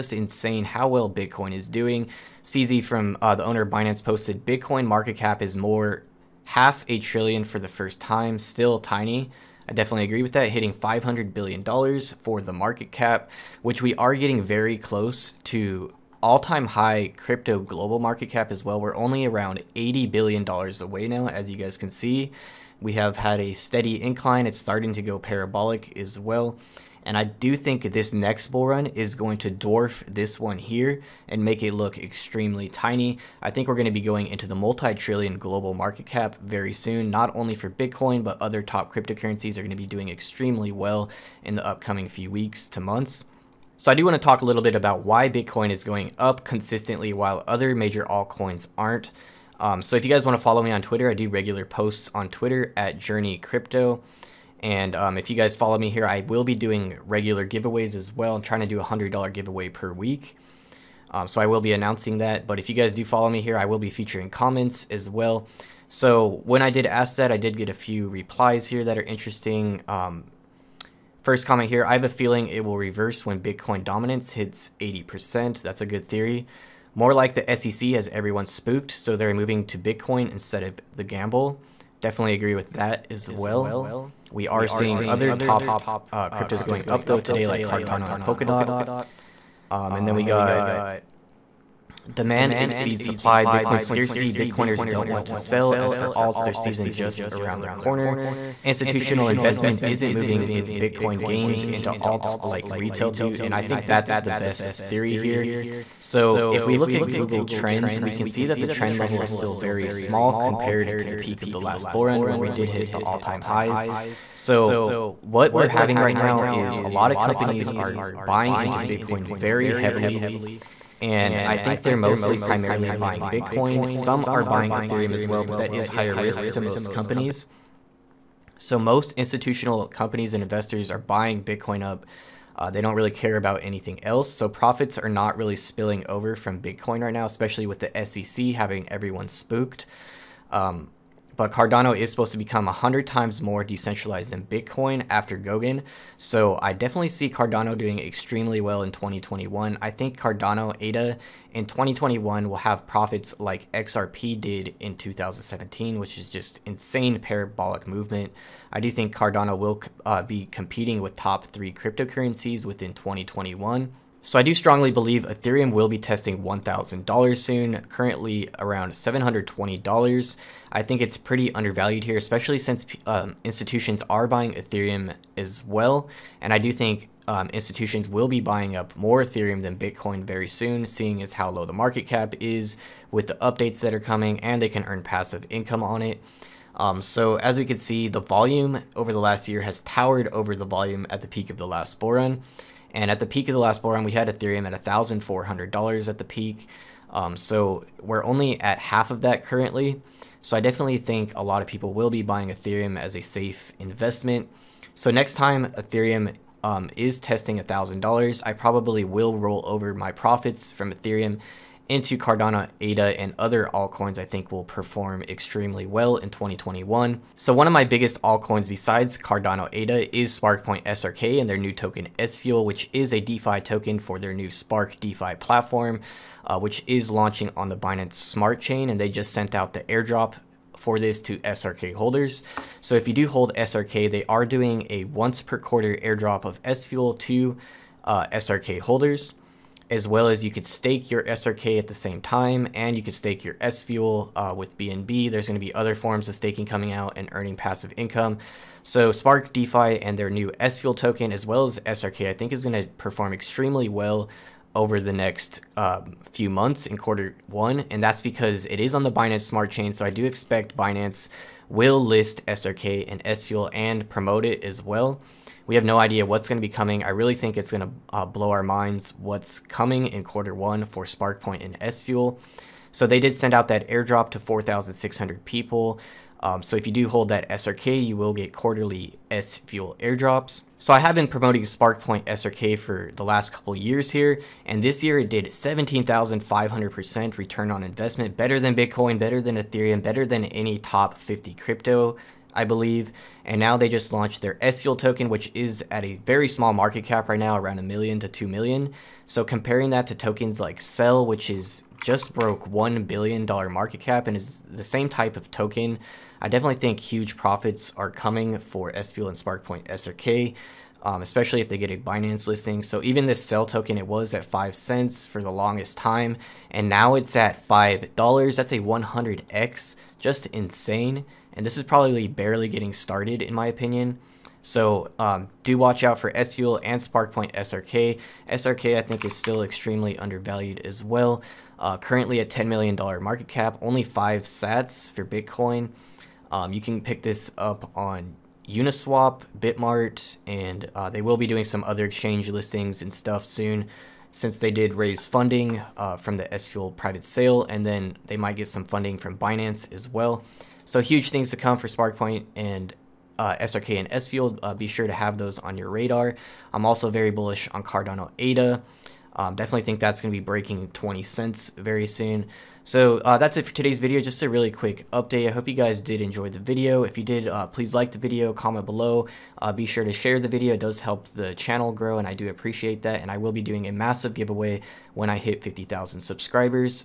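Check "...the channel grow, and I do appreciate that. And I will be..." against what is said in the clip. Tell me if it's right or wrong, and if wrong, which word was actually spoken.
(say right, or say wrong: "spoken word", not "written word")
right.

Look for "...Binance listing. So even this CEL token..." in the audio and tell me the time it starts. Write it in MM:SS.
05:11.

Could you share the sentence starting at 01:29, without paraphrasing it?
Um, and then we got demand exceeds supply, Bitcoin scarcity, Bitcoiners don't want to sell.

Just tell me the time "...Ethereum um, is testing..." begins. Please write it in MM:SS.
03:25.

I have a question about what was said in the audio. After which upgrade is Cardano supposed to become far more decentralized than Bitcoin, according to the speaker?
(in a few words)
Goguen.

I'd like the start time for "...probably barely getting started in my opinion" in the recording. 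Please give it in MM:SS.
05:21.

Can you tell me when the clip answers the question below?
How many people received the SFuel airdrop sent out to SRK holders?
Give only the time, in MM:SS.
04:34.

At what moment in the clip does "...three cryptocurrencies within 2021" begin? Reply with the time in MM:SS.
02:41.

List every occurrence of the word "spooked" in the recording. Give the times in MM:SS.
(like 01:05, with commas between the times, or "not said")
01:18, 02:19.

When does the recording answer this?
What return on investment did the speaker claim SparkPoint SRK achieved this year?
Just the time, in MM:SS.
04:45.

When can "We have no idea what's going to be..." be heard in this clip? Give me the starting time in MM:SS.
04:25.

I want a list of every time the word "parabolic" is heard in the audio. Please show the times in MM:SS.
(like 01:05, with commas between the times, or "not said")
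00:25, 02:37.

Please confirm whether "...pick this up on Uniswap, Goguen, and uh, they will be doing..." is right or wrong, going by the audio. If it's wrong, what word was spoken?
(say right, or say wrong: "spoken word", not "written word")
wrong: "Bitmart", not "Goguen".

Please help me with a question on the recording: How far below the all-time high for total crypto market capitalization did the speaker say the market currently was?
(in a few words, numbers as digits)
$80 billion.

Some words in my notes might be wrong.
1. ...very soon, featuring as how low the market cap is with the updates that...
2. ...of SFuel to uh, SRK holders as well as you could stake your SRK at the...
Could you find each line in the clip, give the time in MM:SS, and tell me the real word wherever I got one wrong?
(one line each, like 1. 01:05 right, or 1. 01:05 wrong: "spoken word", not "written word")
1. 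03:00 wrong: "seeing", not "featuring"
2. 03:56 right.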